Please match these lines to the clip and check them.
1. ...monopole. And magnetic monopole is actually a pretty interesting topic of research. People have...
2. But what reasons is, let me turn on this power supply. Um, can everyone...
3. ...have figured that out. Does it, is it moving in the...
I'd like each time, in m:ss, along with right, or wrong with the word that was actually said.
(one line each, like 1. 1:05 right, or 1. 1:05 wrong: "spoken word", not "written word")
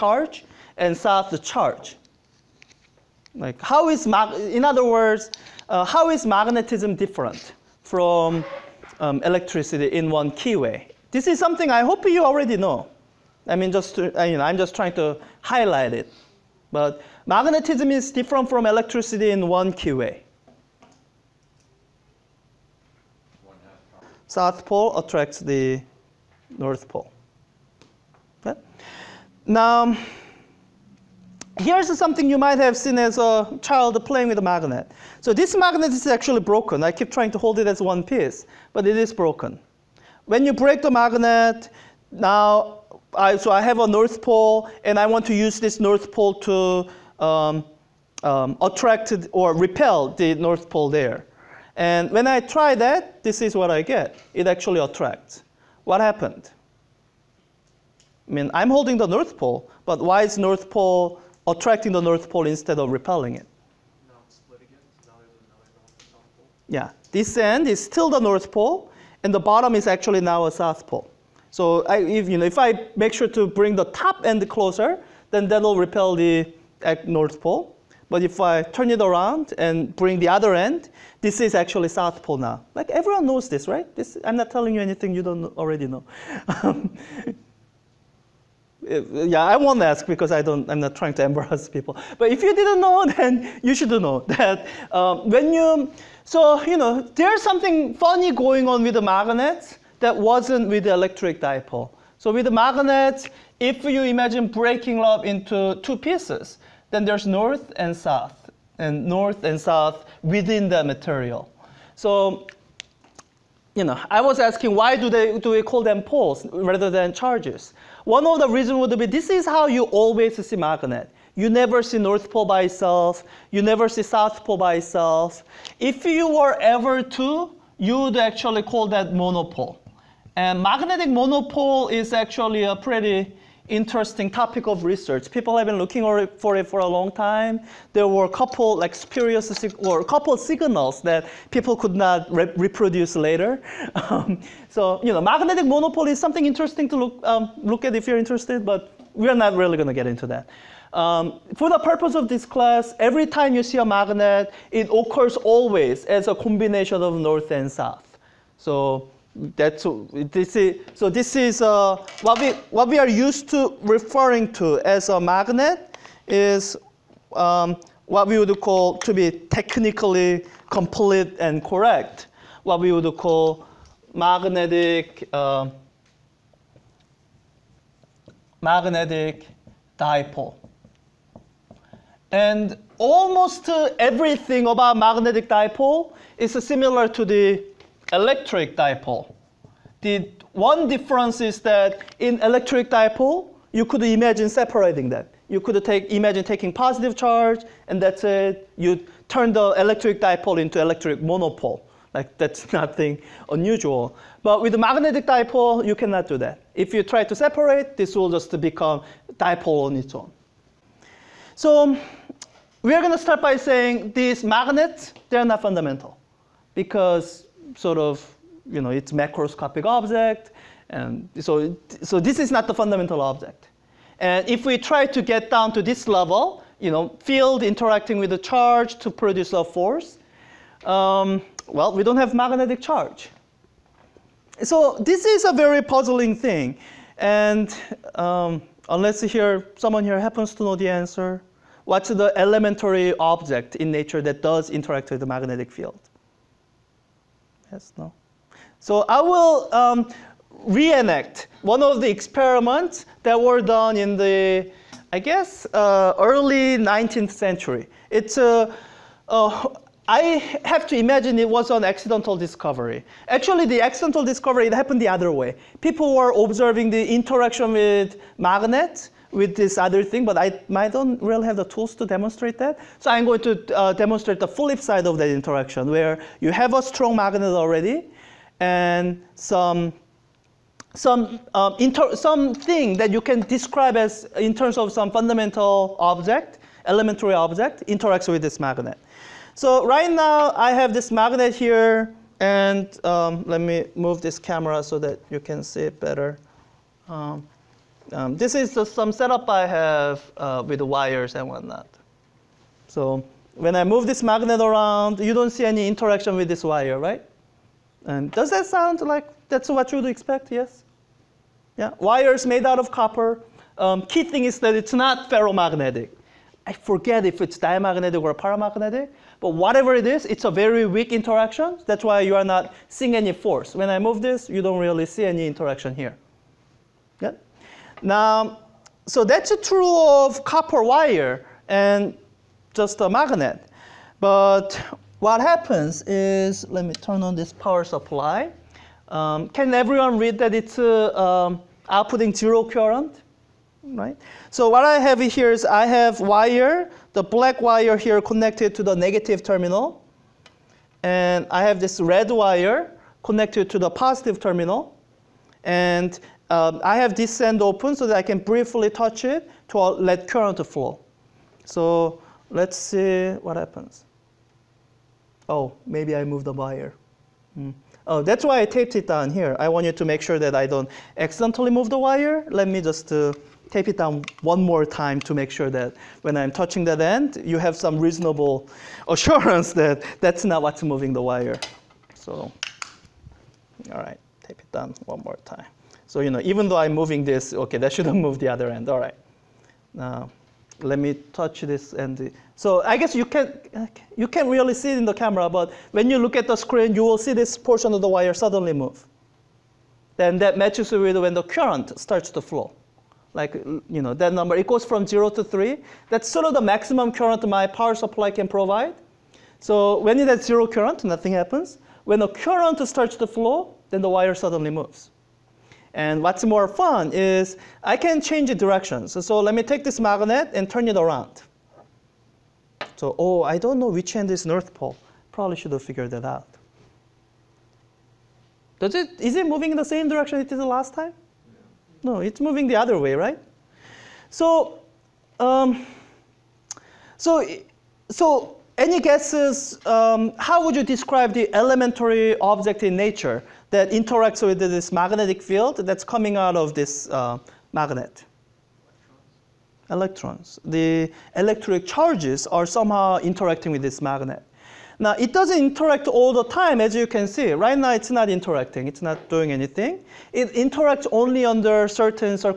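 1. 2:09 right
2. 5:34 wrong: "happens", not "reasons"
3. 7:05 right.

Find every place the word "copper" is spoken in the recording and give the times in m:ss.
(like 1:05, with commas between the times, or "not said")
5:12, 5:30.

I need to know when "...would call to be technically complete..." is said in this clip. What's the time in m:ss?
2:48.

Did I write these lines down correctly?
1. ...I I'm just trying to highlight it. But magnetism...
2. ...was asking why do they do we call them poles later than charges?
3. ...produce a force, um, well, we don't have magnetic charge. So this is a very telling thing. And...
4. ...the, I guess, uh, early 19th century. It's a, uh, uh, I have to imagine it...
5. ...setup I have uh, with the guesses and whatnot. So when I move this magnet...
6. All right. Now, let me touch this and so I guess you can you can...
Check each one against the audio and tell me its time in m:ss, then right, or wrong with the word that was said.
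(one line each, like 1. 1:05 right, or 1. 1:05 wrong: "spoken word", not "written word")
1. 0:14 right
2. 1:54 wrong: "rather", not "later"
3. 3:49 wrong: "puzzling", not "telling"
4. 4:14 right
5. 4:59 wrong: "wires", not "guesses"
6. 6:28 right.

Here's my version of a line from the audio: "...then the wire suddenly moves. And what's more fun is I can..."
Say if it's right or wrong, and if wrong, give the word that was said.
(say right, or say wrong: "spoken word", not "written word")
right.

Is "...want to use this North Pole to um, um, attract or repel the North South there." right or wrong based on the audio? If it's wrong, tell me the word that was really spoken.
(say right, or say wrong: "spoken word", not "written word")
wrong: "Pole", not "South".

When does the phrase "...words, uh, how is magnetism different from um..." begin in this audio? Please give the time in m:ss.
0:04.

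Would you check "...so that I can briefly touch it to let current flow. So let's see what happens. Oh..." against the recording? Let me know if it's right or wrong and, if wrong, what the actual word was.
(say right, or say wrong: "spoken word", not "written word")
right.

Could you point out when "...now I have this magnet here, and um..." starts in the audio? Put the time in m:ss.
4:50.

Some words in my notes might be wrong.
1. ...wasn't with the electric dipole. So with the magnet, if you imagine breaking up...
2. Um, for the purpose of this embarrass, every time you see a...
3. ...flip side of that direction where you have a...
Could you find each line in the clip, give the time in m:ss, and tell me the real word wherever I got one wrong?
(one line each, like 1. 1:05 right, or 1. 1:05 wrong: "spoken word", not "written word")
1. 1:40 right
2. 2:30 wrong: "class", not "embarrass"
3. 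4:34 wrong: "interaction", not "direction".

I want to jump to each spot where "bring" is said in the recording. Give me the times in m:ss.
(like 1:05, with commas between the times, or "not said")
1:13, 1:19.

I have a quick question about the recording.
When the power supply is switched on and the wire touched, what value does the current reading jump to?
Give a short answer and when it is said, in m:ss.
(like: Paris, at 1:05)
3, at 6:45.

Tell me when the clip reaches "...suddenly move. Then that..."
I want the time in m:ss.
6:38.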